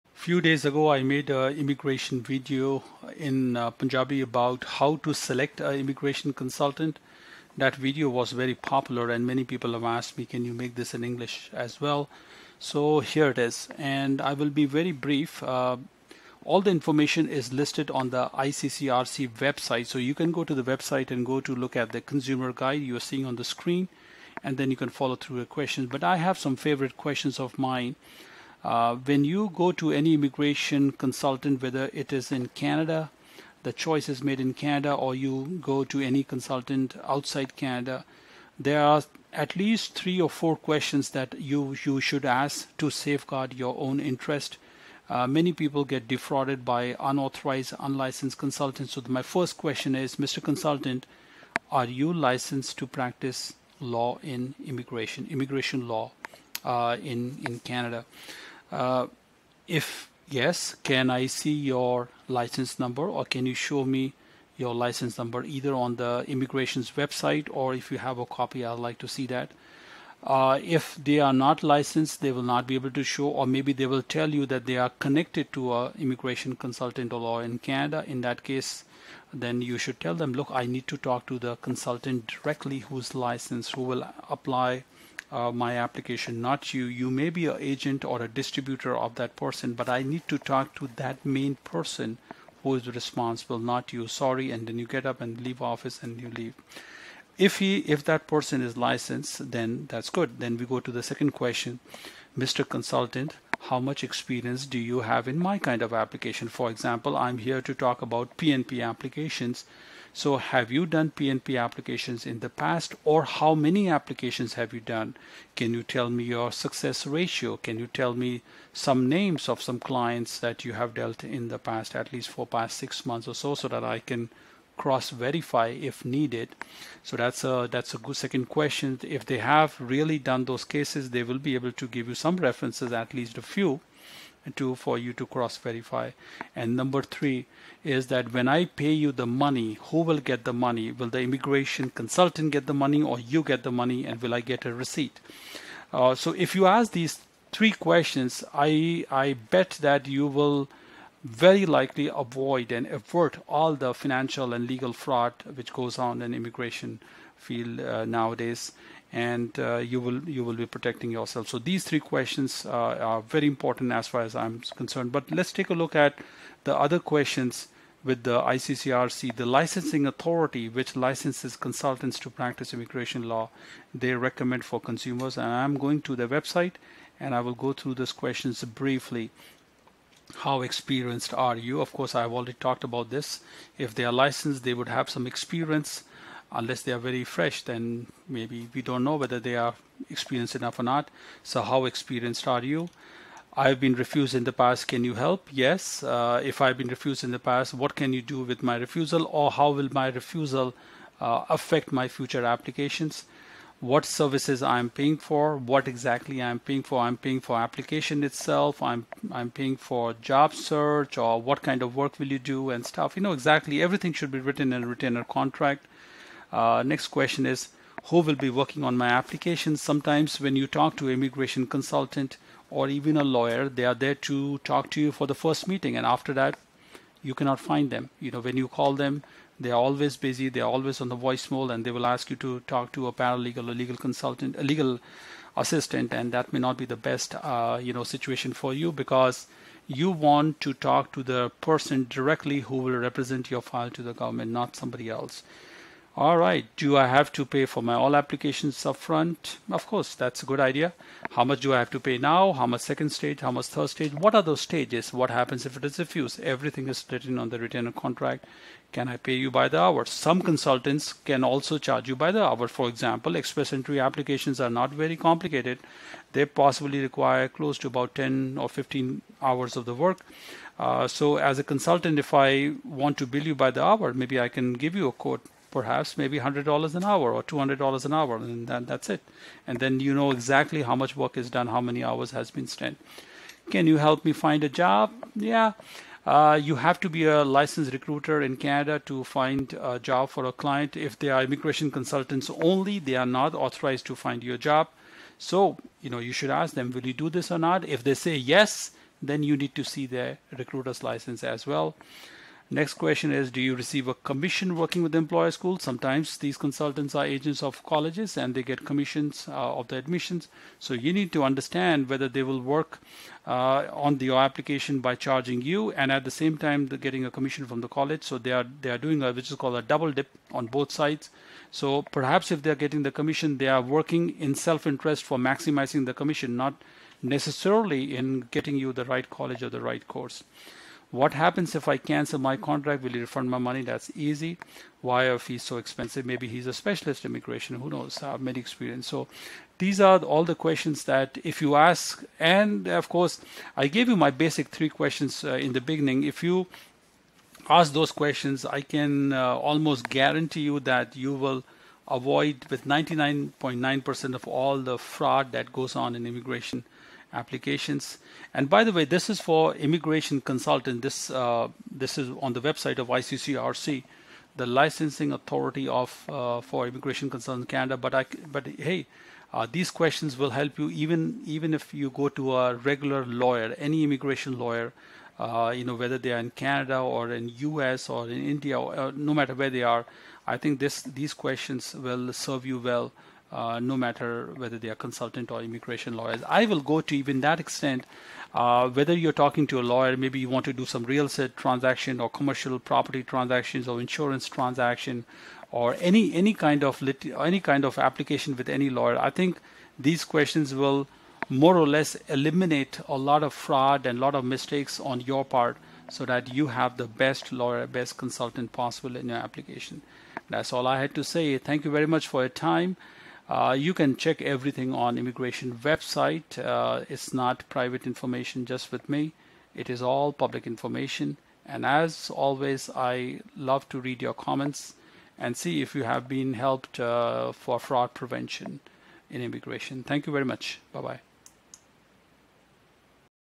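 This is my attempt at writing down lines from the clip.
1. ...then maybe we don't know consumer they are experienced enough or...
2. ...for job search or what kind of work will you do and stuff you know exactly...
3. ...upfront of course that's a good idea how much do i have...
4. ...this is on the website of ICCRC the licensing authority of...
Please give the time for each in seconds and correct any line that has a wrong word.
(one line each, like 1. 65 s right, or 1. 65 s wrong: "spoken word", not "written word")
1. 187 s wrong: "whether", not "consumer"
2. 209 s right
3. 248 s right
4. 361 s right.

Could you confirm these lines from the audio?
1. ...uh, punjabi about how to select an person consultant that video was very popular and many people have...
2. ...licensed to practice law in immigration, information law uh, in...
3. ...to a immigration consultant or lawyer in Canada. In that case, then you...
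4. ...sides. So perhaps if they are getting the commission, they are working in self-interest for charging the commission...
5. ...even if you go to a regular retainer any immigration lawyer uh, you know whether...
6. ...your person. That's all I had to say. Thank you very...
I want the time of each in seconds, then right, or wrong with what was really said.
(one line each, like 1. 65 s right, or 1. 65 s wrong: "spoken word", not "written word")
1. 3 s wrong: "immigration", not "person"
2. 52 s wrong: "immigration", not "information"
3. 75 s right
4. 320 s wrong: "maximizing", not "charging"
5. 371 s wrong: "lawyer", not "retainer"
6. 409 s wrong: "application", not "person".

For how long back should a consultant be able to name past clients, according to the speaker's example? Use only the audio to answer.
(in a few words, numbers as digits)
6 months.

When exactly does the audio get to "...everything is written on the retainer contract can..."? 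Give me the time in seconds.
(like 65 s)
256 s.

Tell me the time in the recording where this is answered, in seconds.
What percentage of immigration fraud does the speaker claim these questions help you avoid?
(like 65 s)
352 s.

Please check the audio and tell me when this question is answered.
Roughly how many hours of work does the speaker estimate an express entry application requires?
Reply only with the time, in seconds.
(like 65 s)
268 s.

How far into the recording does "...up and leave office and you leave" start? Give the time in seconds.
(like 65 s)
95 s.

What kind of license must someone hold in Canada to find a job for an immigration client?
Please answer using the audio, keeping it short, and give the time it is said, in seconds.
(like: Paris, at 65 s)
recruiter's license, at 287 s.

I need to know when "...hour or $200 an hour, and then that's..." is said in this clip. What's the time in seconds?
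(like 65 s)
277 s.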